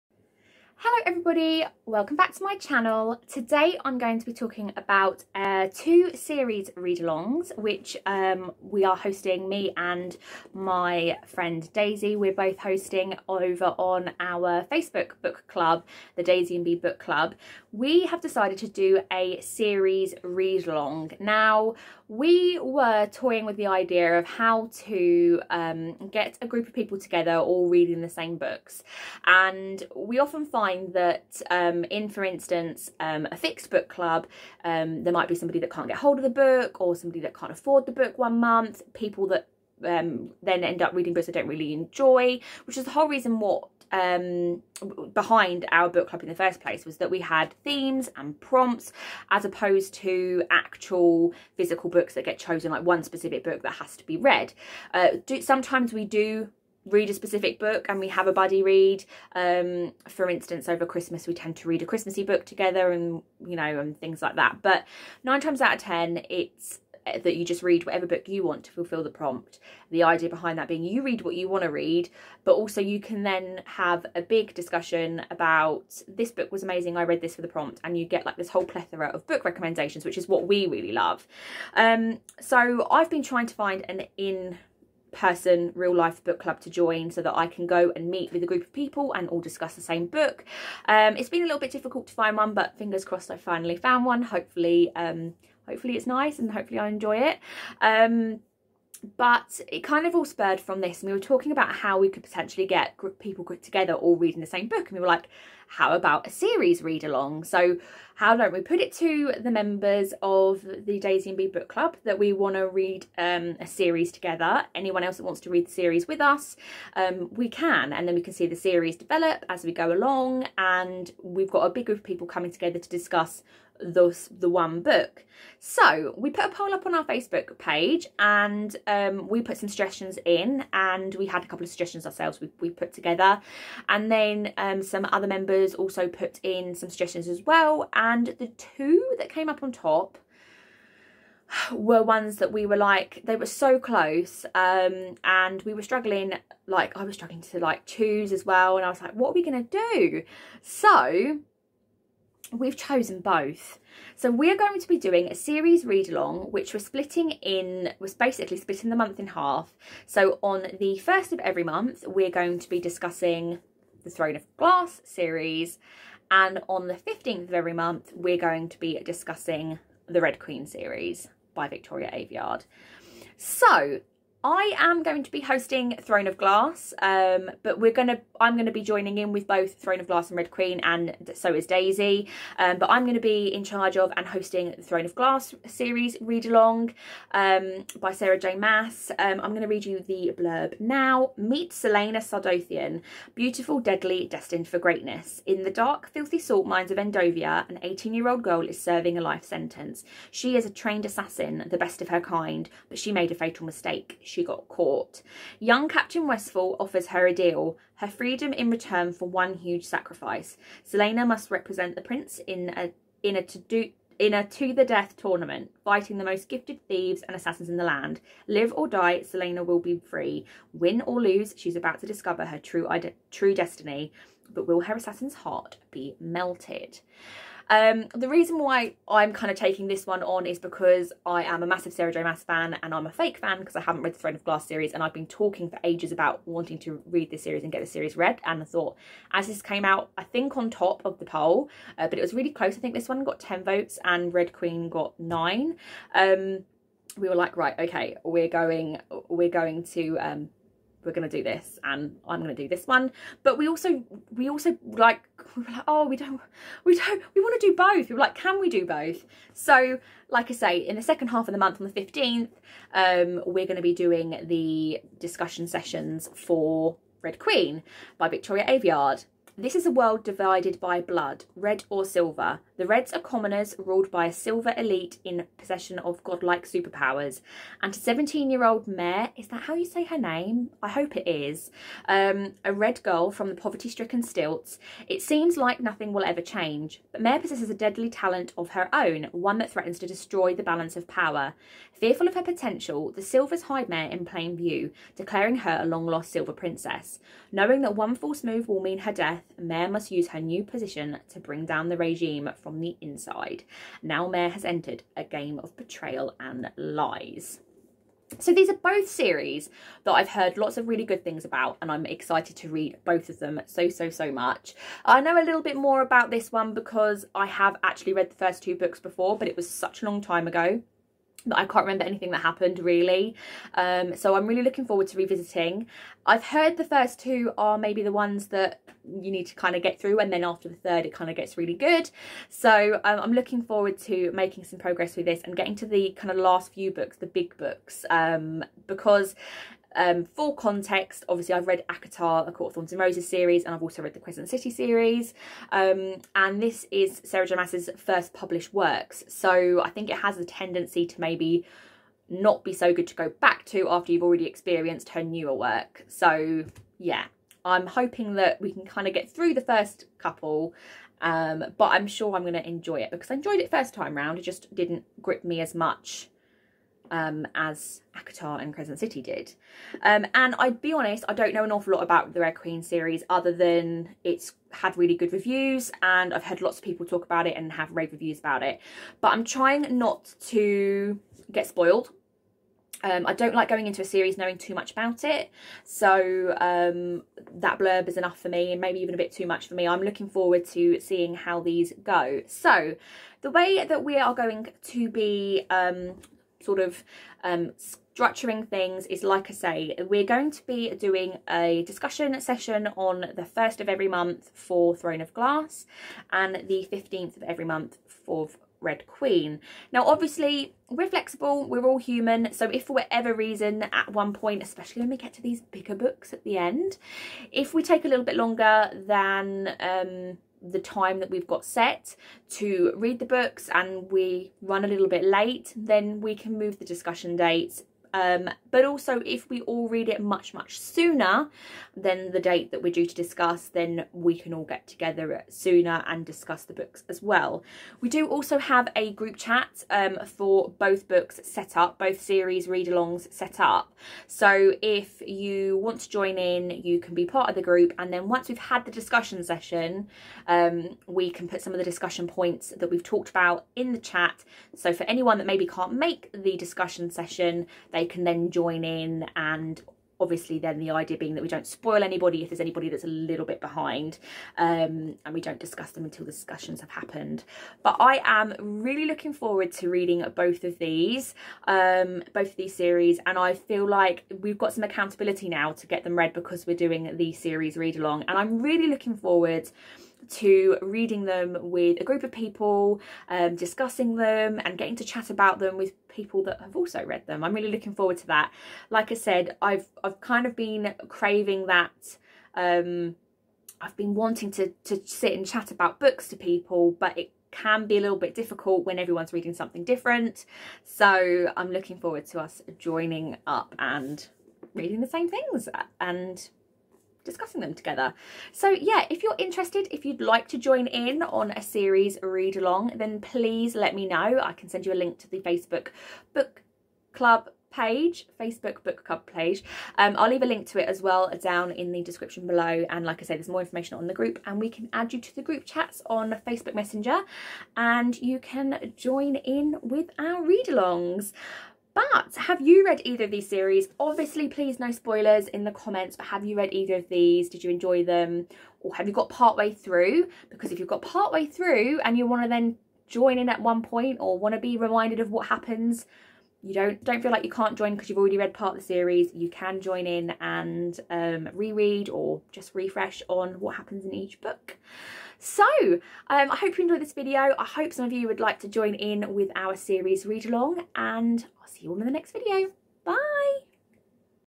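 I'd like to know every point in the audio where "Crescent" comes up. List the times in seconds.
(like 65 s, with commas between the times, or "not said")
344 s, 368 s.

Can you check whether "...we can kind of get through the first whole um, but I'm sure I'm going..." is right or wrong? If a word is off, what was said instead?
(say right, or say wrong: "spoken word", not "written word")
wrong: "couple", not "whole".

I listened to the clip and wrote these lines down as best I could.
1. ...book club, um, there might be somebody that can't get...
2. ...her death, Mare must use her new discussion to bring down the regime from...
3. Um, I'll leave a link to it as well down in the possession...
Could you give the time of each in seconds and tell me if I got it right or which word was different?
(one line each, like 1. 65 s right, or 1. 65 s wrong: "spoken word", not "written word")
1. 33 s right
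2. 298 s wrong: "position", not "discussion"
3. 519 s wrong: "description", not "possession".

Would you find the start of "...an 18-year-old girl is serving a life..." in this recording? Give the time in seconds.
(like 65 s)
197 s.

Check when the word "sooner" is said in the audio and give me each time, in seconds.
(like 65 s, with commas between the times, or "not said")
430 s, 435 s.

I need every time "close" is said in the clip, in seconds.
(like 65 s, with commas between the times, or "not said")
143 s, 242 s.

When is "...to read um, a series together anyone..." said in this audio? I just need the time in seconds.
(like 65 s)
112 s.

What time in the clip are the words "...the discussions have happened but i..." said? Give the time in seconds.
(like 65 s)
466 s.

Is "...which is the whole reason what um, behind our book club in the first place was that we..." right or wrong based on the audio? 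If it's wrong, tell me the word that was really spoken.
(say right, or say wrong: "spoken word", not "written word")
right.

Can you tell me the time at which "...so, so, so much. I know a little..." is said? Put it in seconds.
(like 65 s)
313 s.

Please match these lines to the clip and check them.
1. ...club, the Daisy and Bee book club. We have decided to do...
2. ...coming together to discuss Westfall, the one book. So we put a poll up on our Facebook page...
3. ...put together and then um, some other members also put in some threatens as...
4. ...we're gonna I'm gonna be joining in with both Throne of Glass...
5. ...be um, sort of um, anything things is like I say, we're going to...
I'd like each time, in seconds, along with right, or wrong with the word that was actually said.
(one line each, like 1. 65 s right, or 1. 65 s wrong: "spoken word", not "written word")
1. 15 s right
2. 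122 s wrong: "Thus", not "Westfall"
3. 132 s wrong: "suggestions", not "threatens"
4. 177 s right
5. 395 s wrong: "structuring", not "anything".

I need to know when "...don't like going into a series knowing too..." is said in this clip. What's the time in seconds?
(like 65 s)
383 s.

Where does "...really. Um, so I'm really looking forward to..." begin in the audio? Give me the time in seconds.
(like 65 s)
322 s.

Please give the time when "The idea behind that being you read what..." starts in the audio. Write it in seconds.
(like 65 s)
69 s.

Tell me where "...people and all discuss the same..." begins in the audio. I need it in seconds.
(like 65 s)
88 s.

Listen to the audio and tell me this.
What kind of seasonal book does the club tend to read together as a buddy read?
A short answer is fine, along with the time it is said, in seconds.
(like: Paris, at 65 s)
christmassy book, at 61 s.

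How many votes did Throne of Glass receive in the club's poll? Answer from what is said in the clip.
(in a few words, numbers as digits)
10.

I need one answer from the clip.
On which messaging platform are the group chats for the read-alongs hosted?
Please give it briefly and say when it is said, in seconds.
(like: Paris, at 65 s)
Facebook Messenger, at 526 s.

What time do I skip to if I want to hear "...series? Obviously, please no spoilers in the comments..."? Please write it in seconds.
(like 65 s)
533 s.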